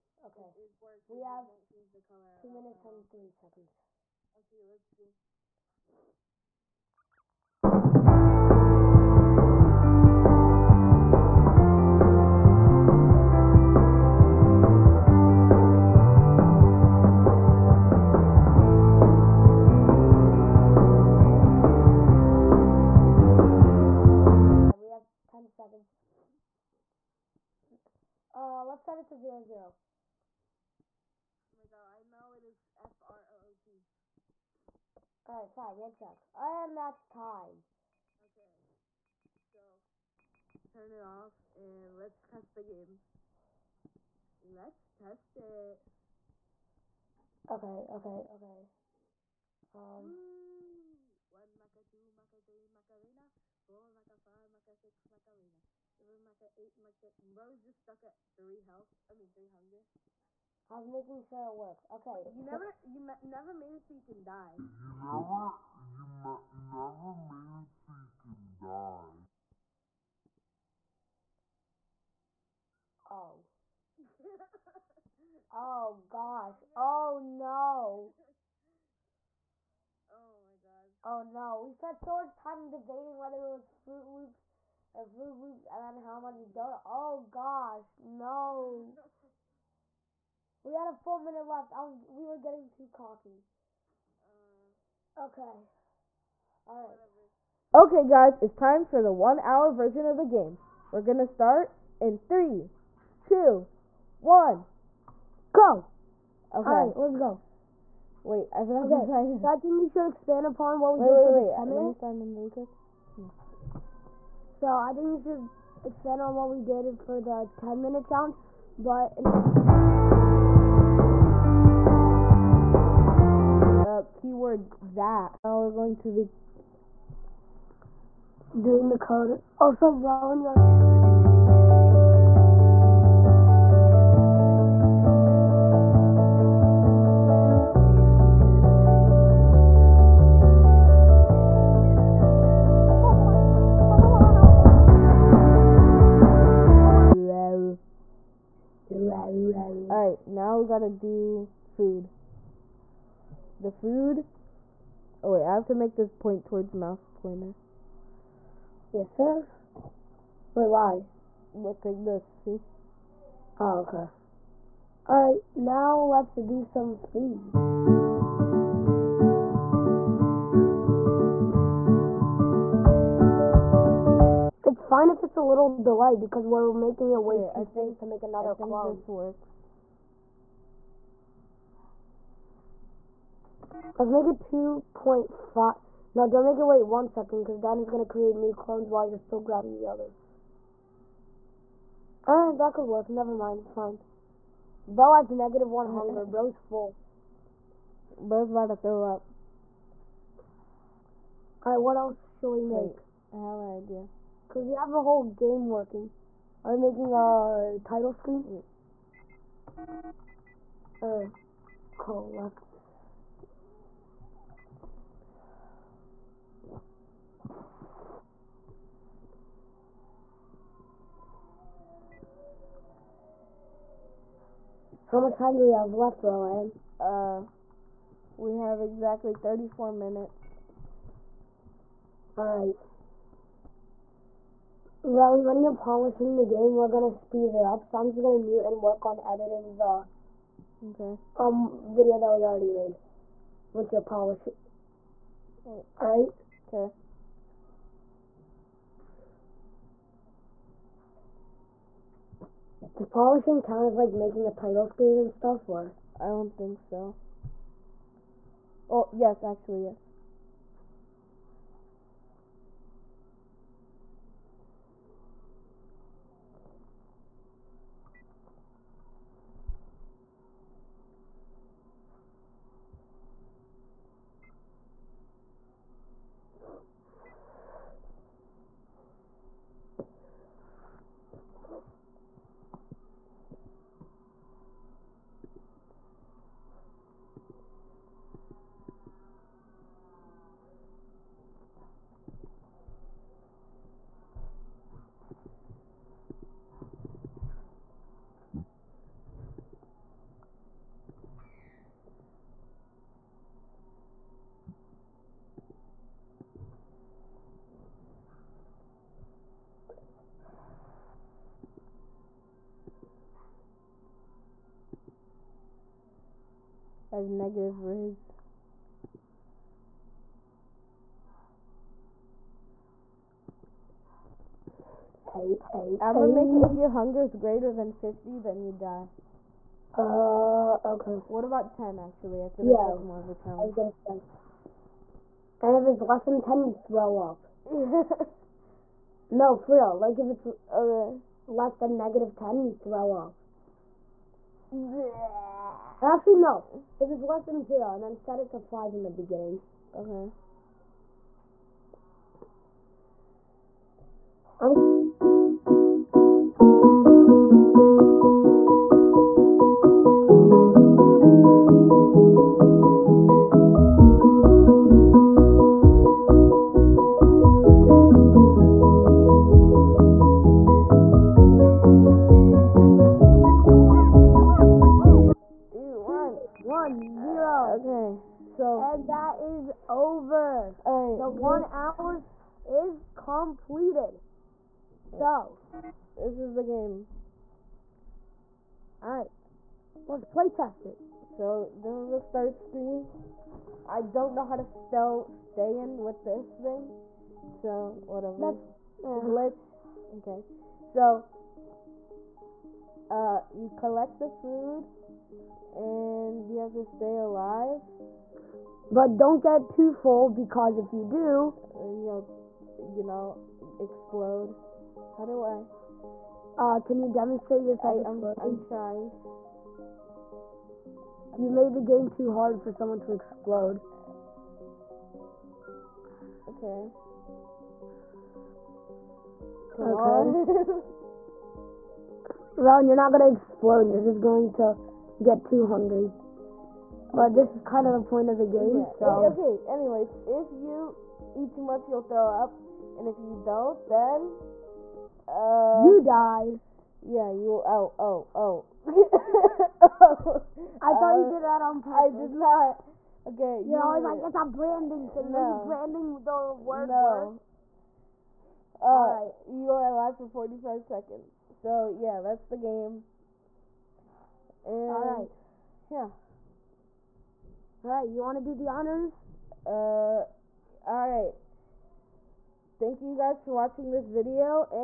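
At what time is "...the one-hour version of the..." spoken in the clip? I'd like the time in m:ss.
1:39.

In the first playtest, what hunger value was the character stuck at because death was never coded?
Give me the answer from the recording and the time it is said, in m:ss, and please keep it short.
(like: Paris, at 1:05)
3, at 0:59.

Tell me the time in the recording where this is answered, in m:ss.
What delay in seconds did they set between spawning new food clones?
3:04.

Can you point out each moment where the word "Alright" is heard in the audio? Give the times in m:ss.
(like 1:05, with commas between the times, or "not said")
2:29, 2:45, 3:21, 6:29.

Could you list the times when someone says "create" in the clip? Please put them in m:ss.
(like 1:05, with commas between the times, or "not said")
3:08.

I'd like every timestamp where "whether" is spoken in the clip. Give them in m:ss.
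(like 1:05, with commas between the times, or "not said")
1:23.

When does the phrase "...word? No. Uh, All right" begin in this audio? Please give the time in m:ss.
7:36.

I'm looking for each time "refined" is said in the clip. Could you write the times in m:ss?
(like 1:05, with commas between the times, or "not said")
not said.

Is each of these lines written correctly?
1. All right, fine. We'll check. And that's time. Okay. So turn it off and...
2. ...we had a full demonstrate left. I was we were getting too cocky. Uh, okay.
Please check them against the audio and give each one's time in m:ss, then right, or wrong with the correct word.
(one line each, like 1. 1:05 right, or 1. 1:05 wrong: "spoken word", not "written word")
1. 0:35 right
2. 1:30 wrong: "minute", not "demonstrate".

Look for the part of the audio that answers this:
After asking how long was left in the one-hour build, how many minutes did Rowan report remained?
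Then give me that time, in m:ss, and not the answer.
3:49.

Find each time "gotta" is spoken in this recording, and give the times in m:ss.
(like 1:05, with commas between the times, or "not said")
2:30.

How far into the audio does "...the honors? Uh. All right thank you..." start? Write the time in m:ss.
7:48.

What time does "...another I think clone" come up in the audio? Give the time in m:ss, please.
2:58.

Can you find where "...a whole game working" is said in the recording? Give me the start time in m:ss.
3:24.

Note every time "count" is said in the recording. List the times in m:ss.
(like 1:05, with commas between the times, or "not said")
4:13.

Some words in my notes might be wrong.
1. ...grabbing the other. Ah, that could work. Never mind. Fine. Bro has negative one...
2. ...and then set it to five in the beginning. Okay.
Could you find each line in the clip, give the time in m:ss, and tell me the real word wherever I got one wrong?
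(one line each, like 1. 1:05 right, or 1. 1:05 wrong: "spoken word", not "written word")
1. 3:09 right
2. 5:47 right.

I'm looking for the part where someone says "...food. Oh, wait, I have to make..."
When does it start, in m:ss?
2:33.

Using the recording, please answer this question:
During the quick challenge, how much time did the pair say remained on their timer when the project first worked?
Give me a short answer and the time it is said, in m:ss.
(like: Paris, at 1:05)
2 minutes and 3 seconds, at 0:02.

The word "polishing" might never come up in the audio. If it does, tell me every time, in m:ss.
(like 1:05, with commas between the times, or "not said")
3:55, 4:03, 4:13.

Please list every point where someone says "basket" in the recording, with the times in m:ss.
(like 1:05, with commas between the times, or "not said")
not said.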